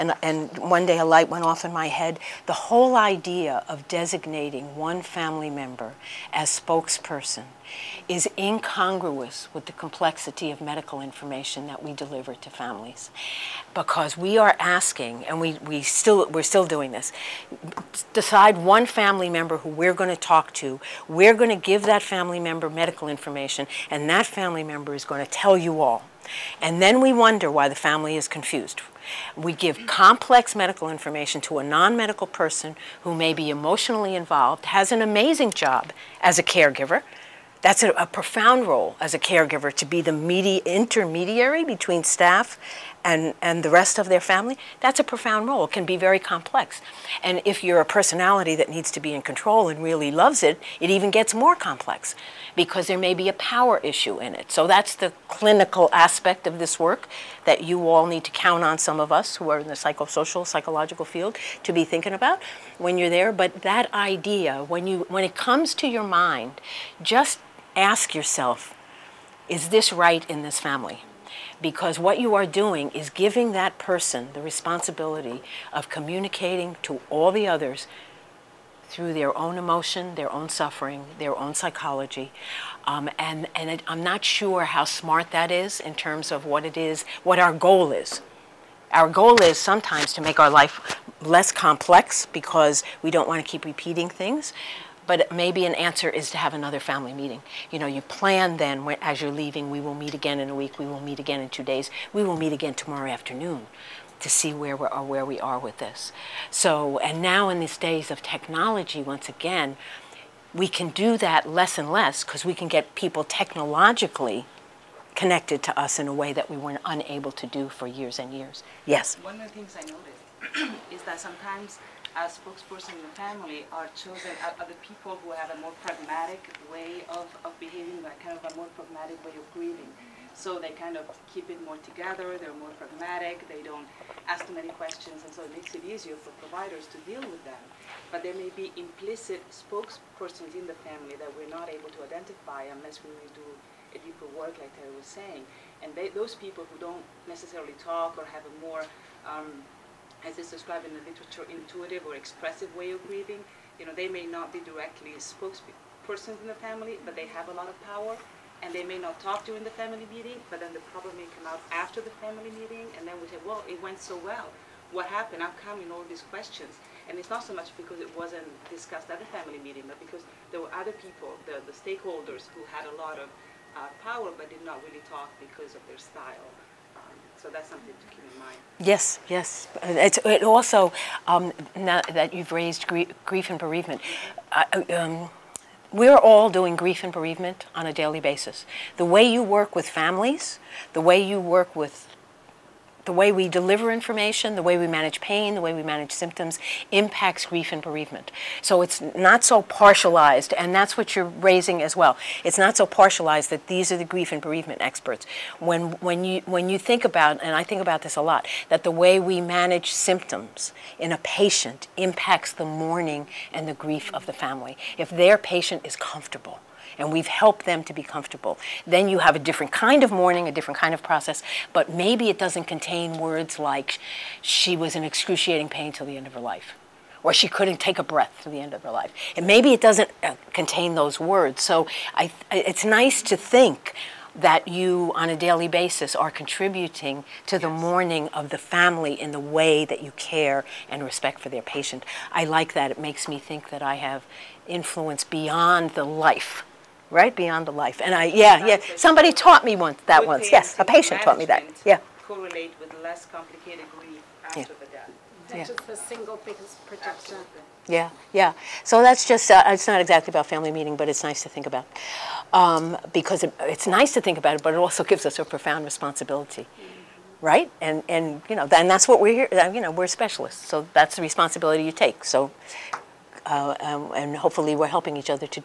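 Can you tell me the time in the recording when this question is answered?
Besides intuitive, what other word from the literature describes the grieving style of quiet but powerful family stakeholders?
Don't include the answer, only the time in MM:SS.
02:32.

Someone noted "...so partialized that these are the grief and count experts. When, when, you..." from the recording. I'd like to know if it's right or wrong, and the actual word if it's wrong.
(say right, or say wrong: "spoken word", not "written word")
wrong: "bereavement", not "count".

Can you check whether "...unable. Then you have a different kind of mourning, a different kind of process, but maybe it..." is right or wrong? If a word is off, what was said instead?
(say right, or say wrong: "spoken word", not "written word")
wrong: "comfortable", not "unable".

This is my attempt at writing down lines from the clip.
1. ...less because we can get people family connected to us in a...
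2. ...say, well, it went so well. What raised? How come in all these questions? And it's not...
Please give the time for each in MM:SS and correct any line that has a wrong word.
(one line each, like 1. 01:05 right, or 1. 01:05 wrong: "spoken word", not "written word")
1. 01:51 wrong: "technologically", not "family"
2. 02:43 wrong: "happened", not "raised".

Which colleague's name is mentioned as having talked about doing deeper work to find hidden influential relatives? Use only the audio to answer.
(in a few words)
Terry.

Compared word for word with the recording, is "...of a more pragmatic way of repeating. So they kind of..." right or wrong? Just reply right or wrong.
wrong.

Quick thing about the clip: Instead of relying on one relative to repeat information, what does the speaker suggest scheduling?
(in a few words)
another family meeting.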